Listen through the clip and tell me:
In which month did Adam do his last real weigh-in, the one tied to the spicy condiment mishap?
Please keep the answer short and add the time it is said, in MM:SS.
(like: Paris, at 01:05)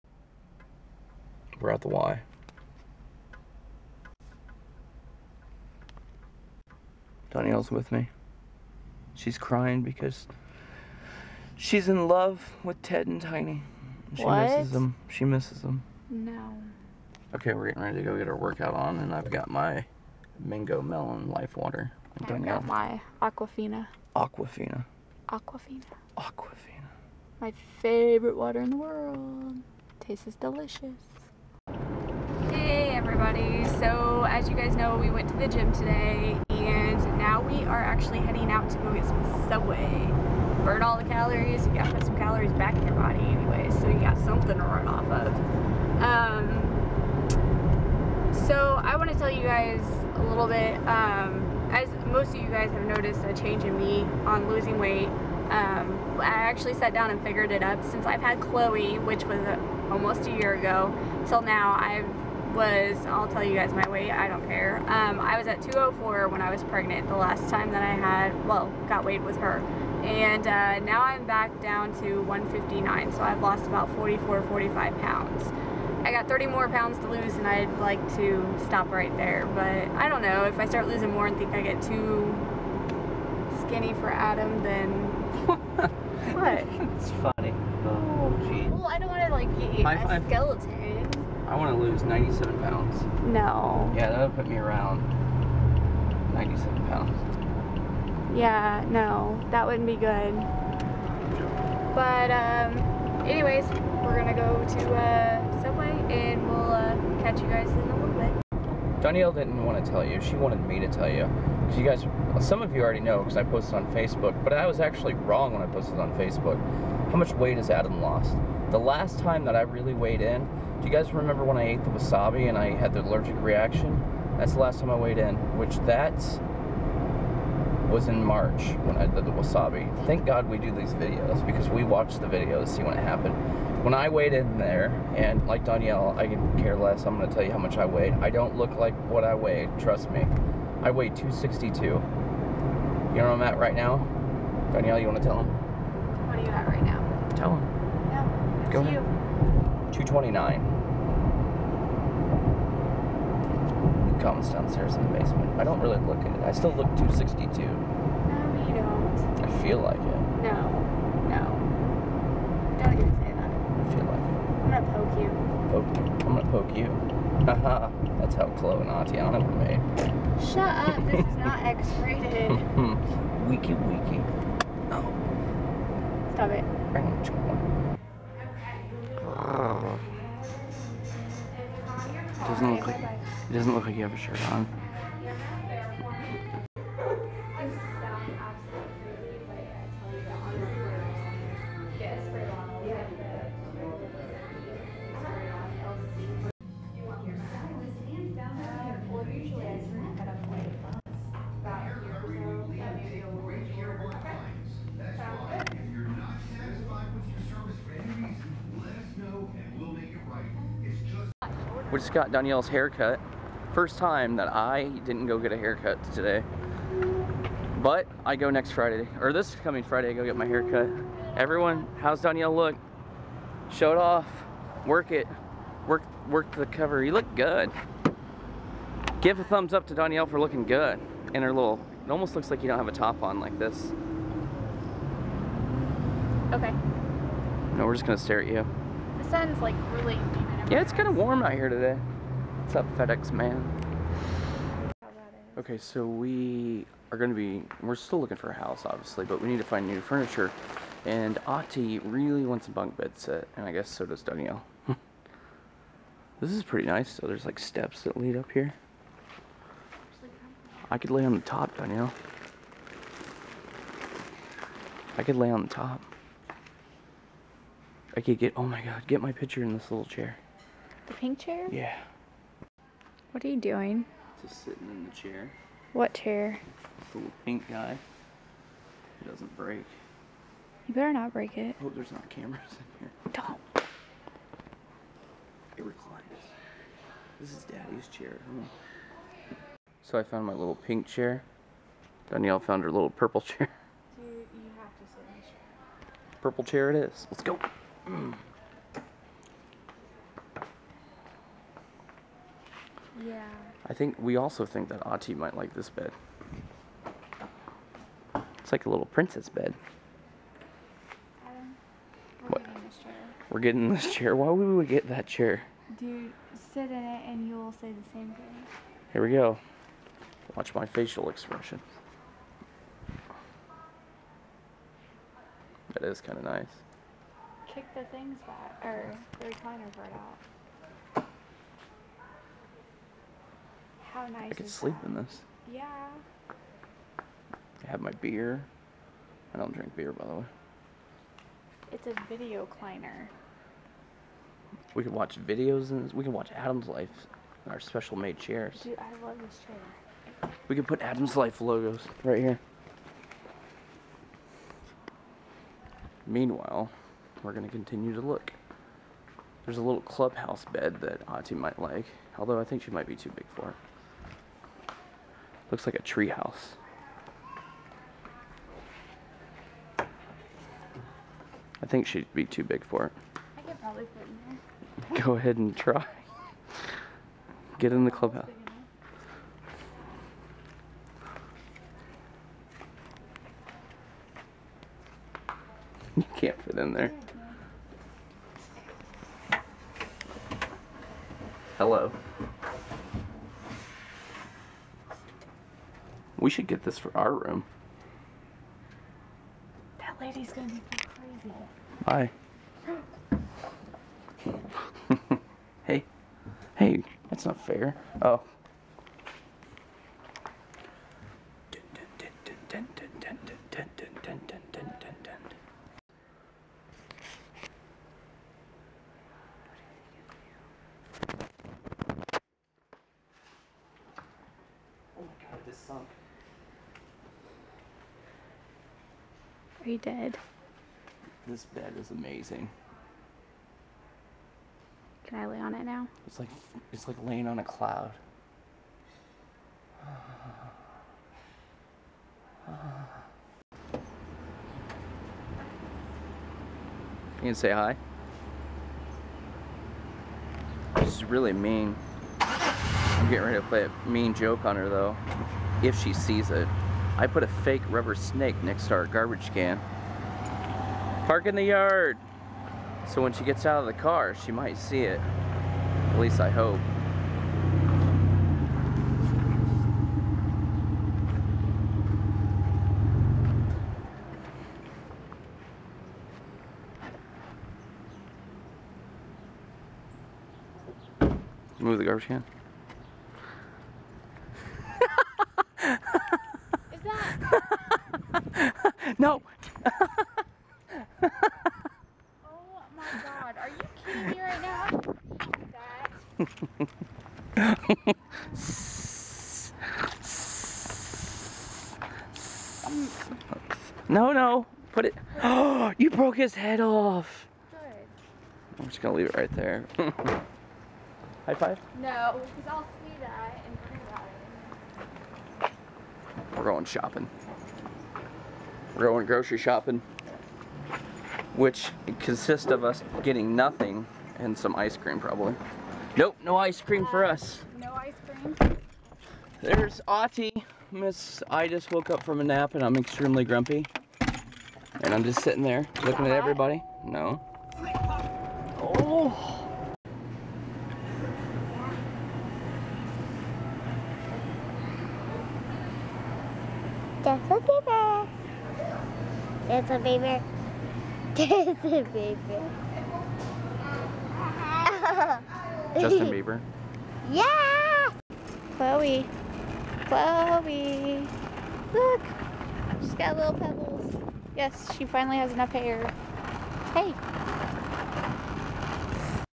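March, at 02:08.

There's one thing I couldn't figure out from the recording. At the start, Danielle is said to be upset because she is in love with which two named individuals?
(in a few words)
Ted and Tiny.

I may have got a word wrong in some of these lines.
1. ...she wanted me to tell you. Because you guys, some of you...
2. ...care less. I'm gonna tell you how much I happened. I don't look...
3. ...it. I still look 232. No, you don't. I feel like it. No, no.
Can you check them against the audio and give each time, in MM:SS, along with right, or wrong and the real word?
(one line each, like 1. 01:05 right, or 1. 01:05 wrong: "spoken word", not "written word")
1. 01:50 right
2. 02:16 wrong: "weighed", not "happened"
3. 02:36 wrong: "262", not "232".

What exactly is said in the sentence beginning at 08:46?
Nope, no ice cream for us.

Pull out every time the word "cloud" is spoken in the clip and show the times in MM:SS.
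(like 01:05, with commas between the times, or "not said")
07:17.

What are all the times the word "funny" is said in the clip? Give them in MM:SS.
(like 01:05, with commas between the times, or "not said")
01:27.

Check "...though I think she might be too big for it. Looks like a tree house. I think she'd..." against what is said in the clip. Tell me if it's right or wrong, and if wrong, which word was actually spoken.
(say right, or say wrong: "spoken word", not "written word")
wrong: "although", not "though".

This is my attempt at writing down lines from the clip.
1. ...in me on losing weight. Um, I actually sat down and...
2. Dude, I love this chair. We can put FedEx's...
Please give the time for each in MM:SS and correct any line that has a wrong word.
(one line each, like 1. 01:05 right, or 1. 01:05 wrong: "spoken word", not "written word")
1. 00:53 right
2. 05:48 wrong: "Adam", not "FedEx".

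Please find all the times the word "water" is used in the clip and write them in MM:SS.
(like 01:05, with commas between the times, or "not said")
00:21, 00:28.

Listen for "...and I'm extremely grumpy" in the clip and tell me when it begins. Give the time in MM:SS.
08:52.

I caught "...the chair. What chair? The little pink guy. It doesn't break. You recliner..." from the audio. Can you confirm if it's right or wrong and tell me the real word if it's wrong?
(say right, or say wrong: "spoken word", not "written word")
wrong: "better", not "recliner".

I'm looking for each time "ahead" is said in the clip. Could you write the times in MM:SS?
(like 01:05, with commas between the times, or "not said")
02:28, 06:15.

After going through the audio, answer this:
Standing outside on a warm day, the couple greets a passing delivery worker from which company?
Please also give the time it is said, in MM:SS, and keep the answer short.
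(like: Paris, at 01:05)
FedEx, at 04:02.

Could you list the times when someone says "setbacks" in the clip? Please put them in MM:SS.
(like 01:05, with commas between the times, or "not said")
not said.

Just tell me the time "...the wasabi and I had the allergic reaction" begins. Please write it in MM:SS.
02:01.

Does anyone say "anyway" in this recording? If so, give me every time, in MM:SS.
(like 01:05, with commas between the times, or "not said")
00:43, 01:43.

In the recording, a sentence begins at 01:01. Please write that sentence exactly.
I've was I'll tell you guys my weight, I don't care.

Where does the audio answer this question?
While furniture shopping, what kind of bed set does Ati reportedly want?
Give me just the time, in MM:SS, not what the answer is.
04:12.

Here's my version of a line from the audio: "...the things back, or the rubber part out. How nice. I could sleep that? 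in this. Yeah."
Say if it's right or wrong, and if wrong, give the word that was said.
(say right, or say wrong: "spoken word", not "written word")
wrong: "recliner", not "rubber".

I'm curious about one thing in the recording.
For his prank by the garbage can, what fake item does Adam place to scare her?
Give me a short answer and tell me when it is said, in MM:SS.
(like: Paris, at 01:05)
rubber snake, at 07:37.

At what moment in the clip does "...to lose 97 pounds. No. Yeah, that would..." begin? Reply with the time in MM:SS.
01:31.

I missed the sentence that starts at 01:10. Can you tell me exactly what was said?
And uh, now I'm back down to 159, so I've lost about 44, 45 pounds.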